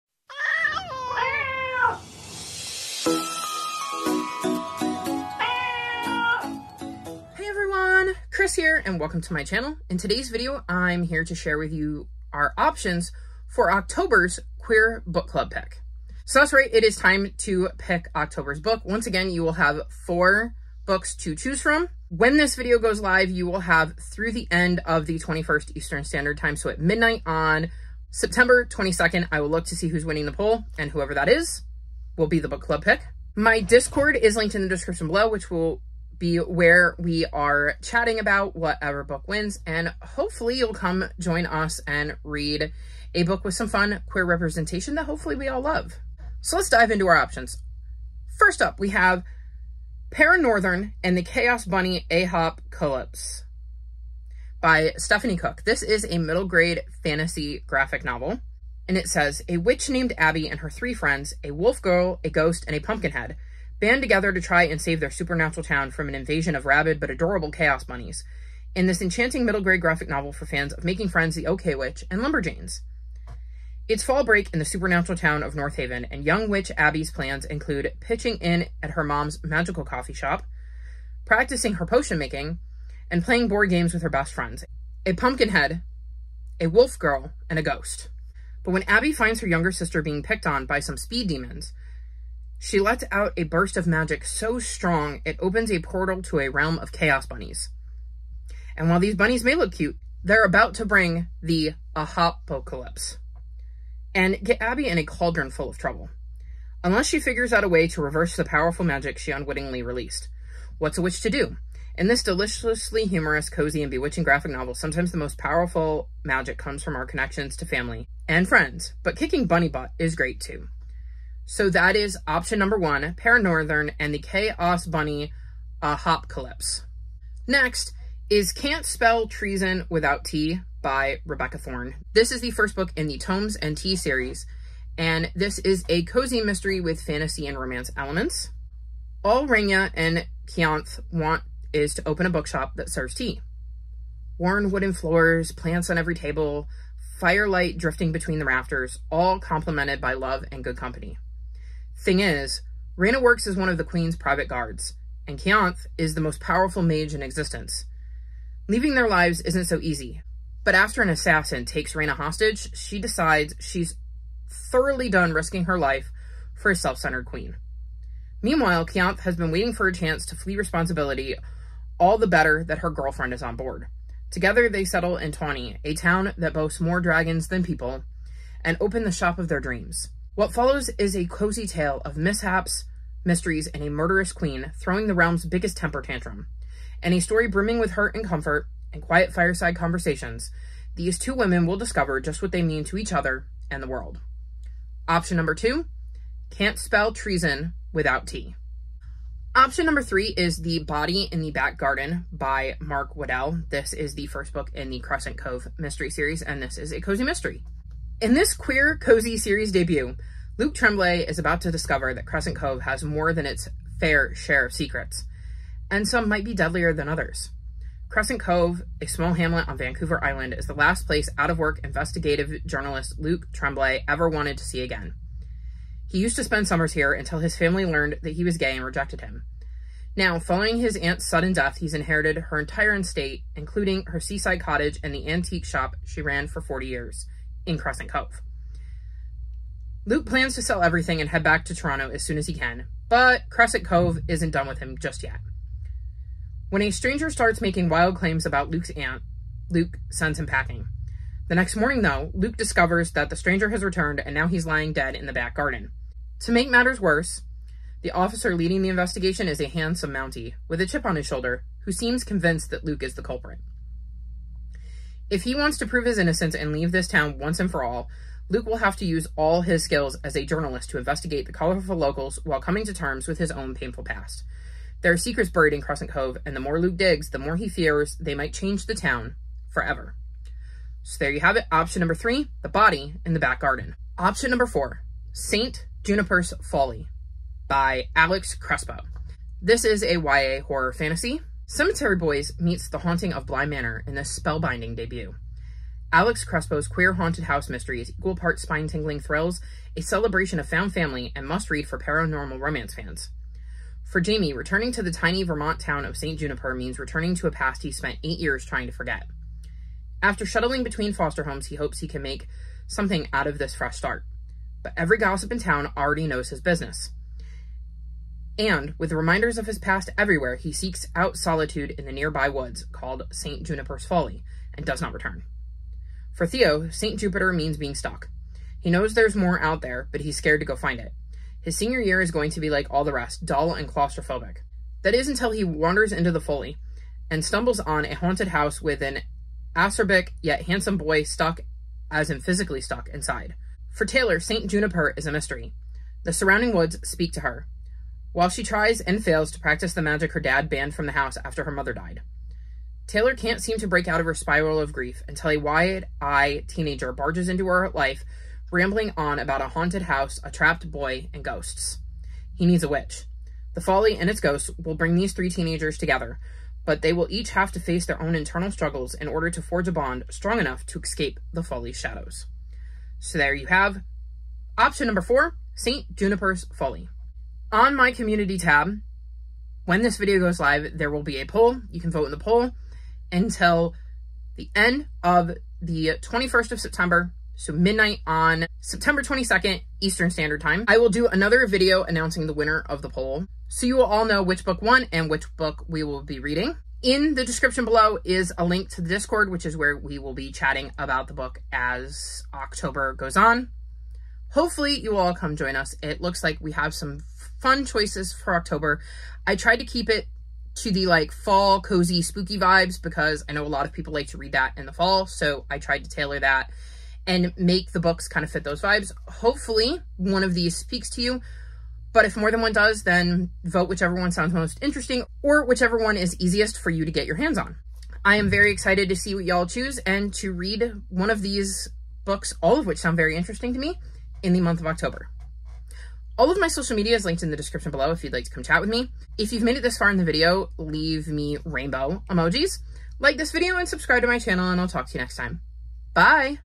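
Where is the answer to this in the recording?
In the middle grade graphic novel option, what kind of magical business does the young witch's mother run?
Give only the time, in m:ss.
1:19.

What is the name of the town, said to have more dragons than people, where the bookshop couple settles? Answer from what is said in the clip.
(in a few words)
Tawney.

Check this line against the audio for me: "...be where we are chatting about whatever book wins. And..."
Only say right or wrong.
right.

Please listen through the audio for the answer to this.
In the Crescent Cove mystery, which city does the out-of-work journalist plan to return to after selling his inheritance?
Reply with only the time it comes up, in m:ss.
4:01.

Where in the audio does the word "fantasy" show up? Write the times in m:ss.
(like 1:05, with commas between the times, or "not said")
0:57, 2:17, 4:50.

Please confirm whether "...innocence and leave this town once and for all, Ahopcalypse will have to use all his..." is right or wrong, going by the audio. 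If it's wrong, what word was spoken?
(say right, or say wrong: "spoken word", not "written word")
wrong: "Luke", not "Ahopcalypse".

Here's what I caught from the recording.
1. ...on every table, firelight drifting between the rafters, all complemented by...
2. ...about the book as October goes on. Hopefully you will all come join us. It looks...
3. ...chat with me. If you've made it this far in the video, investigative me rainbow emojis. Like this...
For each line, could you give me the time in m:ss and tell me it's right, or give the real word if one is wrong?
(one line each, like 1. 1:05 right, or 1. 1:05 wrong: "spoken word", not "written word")
1. 2:25 right
2. 6:40 right
3. 7:18 wrong: "leave", not "investigative".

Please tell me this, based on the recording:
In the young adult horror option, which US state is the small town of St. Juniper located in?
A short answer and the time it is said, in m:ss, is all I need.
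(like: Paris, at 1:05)
Vermont, at 5:05.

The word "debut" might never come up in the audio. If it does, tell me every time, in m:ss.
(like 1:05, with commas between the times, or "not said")
3:29, 4:54.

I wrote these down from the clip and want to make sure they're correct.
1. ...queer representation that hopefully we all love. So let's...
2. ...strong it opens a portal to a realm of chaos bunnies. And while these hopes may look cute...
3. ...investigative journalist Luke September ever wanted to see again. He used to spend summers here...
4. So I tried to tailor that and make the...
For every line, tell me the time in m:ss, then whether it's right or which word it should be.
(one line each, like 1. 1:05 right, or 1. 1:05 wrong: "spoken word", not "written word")
1. 0:44 right
2. 1:34 wrong: "bunnies", not "hopes"
3. 3:41 wrong: "Tremblay", not "September"
4. 6:55 right.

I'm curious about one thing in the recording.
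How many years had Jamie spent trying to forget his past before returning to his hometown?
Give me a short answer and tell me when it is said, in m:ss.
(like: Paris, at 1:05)
8, at 5:08.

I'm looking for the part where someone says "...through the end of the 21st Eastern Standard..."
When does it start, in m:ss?
0:23.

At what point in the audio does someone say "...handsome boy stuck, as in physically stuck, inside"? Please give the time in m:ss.
5:40.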